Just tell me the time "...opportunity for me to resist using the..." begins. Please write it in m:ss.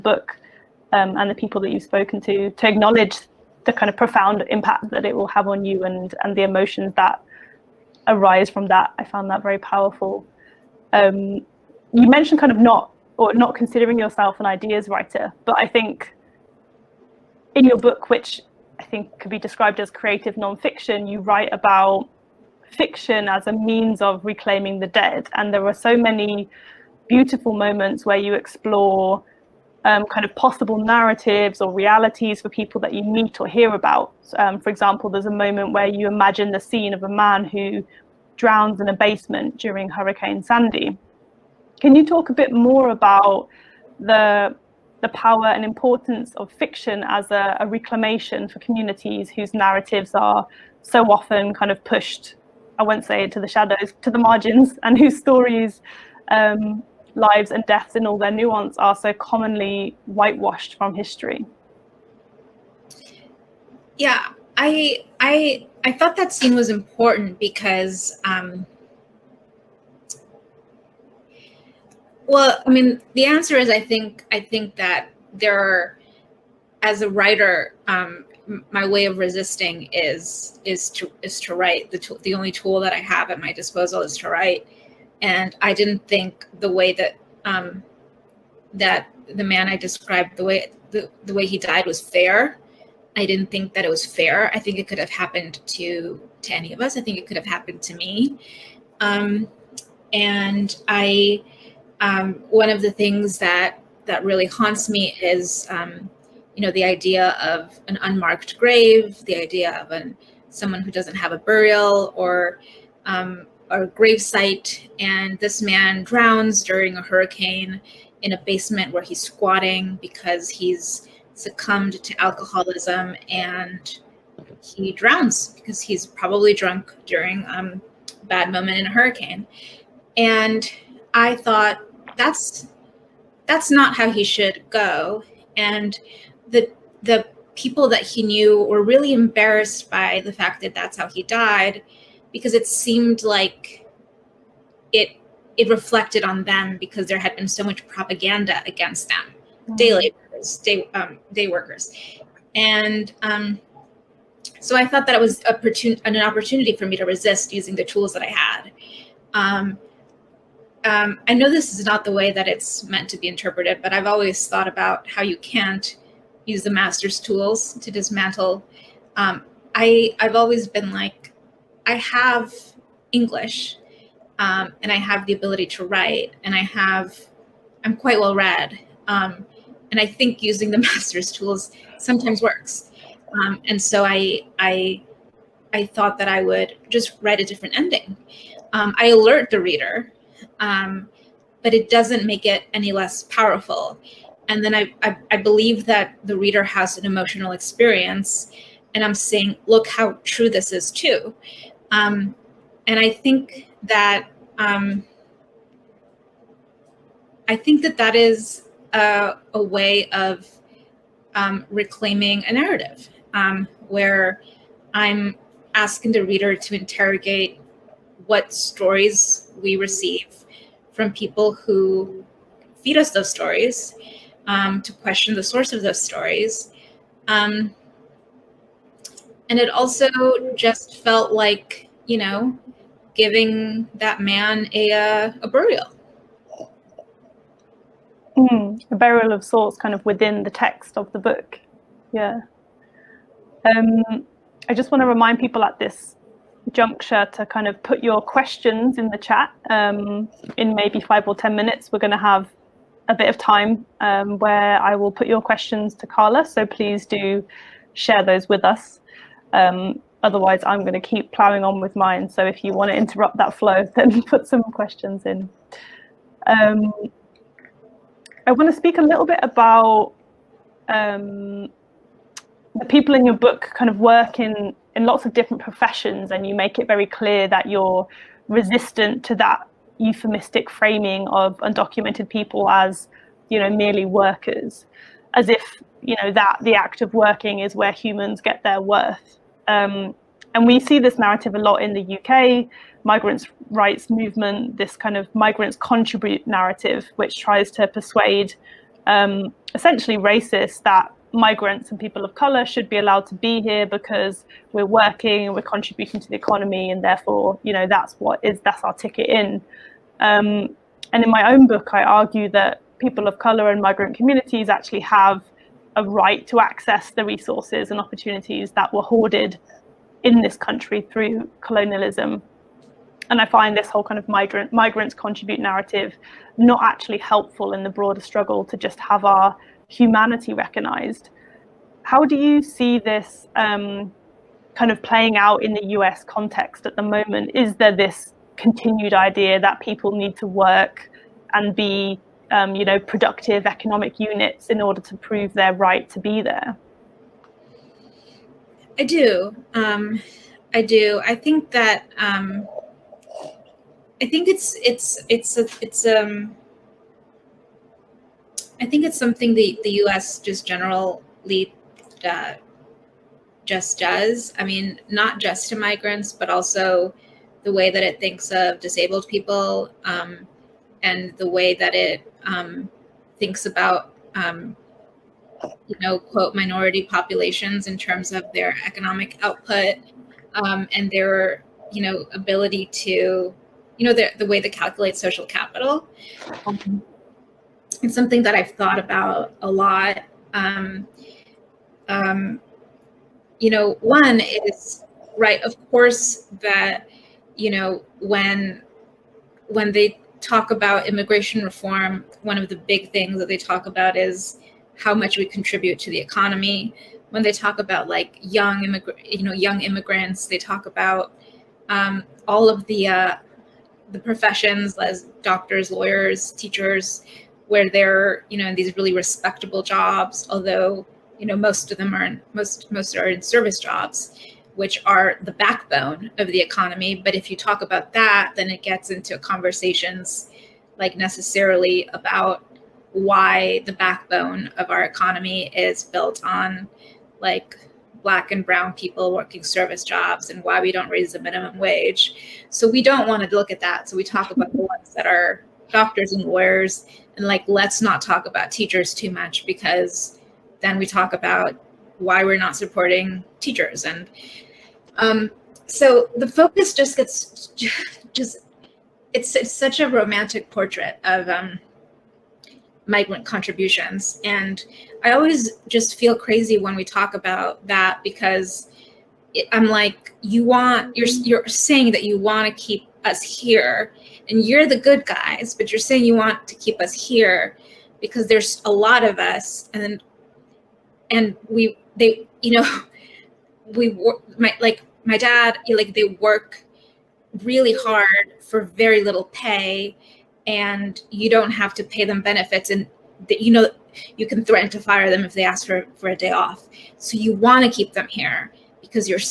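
2:36.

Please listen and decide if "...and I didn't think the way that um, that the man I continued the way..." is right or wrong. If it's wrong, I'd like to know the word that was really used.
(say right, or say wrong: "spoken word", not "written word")
wrong: "described", not "continued".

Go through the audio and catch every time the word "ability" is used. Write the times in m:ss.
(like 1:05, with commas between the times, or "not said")
2:55, 6:22.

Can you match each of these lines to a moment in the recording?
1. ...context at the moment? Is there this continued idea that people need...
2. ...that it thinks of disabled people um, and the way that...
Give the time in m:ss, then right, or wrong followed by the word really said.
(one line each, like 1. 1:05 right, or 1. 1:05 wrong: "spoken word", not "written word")
1. 5:36 right
2. 6:07 right.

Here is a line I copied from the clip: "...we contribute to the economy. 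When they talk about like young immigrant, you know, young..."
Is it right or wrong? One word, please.
right.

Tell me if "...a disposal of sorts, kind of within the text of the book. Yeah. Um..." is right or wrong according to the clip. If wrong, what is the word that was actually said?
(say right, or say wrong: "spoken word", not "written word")
wrong: "burial", not "disposal".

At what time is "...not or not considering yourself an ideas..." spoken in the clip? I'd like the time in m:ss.
0:12.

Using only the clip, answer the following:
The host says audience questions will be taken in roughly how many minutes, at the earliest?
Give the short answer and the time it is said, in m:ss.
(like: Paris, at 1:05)
5, at 4:10.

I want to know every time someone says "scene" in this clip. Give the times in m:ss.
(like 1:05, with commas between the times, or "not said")
0:36, 1:06.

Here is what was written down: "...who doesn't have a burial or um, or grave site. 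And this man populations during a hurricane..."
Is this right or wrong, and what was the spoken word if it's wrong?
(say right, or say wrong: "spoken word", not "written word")
wrong: "drowns", not "populations".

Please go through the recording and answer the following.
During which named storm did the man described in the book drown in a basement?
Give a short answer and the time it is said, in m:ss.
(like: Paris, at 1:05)
Hurricane Sandy, at 0:39.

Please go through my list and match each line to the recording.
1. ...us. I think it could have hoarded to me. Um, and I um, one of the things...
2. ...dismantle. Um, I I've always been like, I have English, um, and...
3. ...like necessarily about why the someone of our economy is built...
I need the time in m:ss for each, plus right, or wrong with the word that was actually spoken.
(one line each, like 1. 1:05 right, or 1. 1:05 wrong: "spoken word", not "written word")
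1. 1:36 wrong: "happened", not "hoarded"
2. 2:47 right
3. 7:10 wrong: "backbone", not "someone".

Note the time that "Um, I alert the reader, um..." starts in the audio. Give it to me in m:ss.
3:08.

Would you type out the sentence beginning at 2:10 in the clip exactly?
And I thought that's that's not how he should go.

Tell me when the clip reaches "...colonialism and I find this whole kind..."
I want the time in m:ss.
5:21.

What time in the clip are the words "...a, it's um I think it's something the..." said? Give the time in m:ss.
5:55.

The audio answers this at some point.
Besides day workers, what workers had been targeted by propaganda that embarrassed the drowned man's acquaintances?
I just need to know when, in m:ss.
2:29.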